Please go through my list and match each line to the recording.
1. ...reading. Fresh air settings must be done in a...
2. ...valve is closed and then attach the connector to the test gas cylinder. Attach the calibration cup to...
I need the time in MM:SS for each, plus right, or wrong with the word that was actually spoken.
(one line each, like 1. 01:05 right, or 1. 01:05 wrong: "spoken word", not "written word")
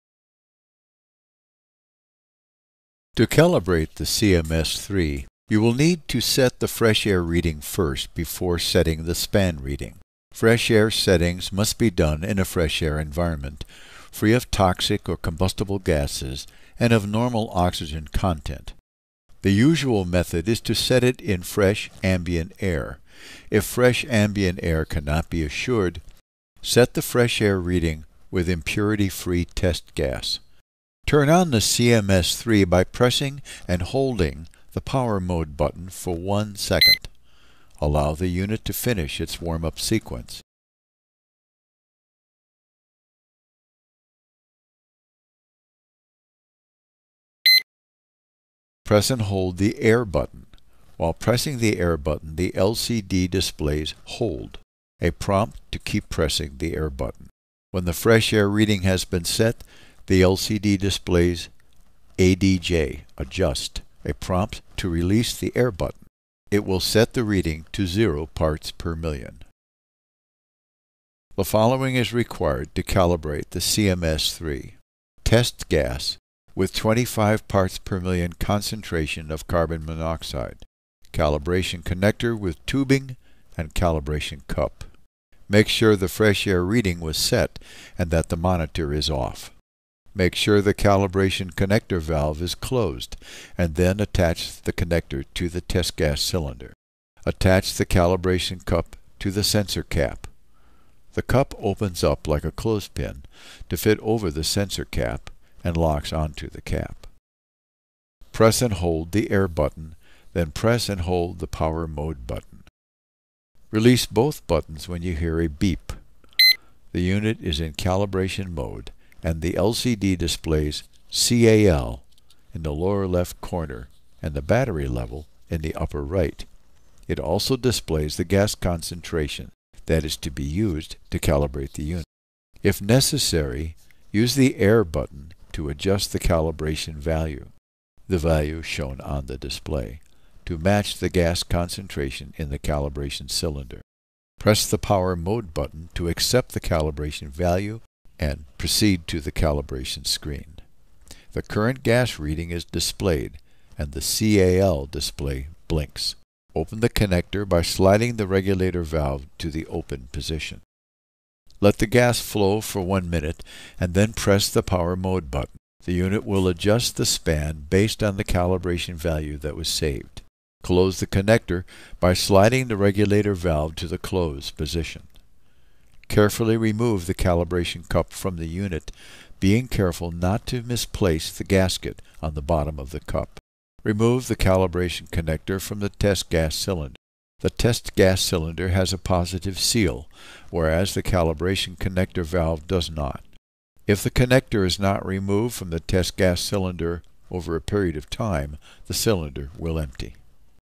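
1. 00:09 right
2. 01:32 right.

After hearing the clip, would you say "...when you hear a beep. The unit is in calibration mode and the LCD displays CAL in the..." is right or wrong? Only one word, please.
right.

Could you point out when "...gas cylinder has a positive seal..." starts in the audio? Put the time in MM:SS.
03:07.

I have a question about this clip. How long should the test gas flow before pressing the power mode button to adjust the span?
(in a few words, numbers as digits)
1 minute.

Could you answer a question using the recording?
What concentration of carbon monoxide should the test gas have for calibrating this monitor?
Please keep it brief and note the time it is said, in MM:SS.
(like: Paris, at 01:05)
25 parts per million, at 01:16.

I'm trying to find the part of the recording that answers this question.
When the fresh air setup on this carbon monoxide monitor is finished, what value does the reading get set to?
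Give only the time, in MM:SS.
01:07.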